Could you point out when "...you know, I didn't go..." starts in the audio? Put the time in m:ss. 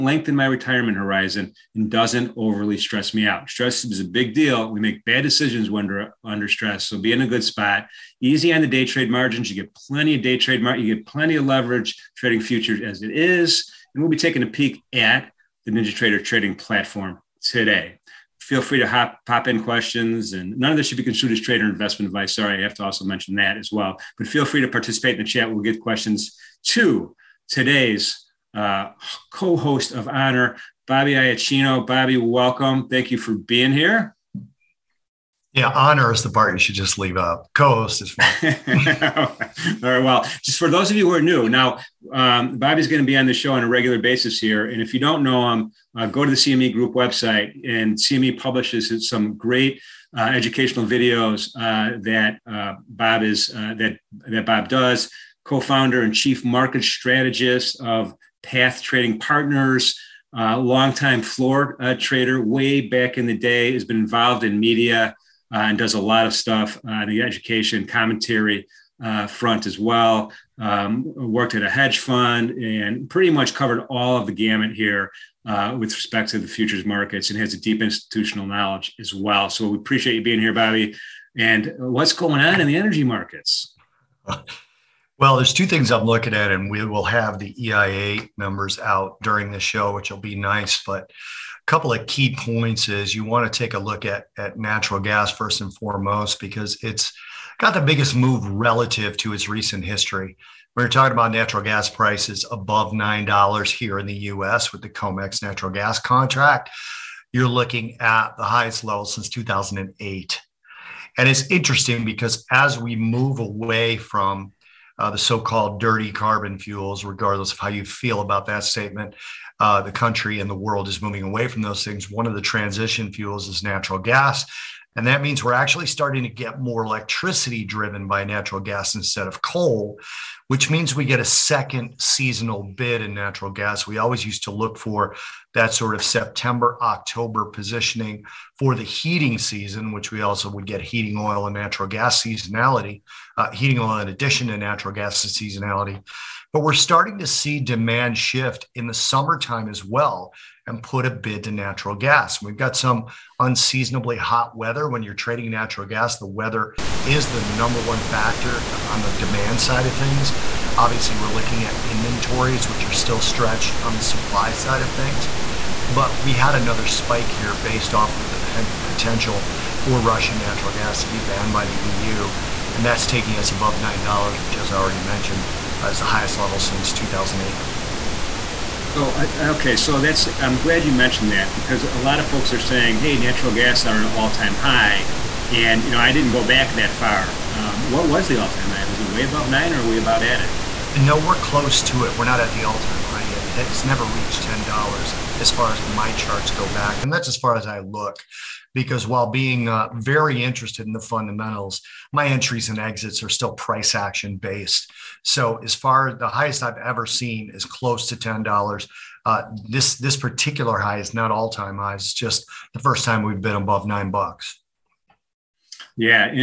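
3:05.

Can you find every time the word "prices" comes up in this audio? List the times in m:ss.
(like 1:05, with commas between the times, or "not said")
1:41, 3:23.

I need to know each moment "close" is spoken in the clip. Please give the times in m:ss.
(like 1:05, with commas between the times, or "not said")
3:11, 3:27.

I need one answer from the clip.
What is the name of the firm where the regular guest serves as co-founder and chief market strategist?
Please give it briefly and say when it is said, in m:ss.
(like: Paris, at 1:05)
Path Trading Partners, at 0:58.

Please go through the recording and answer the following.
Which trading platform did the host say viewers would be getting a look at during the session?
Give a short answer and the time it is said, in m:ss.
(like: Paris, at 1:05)
NinjaTrader, at 0:15.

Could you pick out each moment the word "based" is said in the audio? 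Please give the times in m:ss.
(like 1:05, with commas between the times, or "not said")
2:47, 3:24.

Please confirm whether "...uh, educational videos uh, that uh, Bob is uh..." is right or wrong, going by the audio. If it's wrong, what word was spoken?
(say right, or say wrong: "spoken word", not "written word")
right.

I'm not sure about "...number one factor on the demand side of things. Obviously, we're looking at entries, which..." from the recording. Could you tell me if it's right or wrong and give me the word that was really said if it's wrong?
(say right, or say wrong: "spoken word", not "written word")
wrong: "inventories", not "entries".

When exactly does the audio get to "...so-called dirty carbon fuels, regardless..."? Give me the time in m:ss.
1:55.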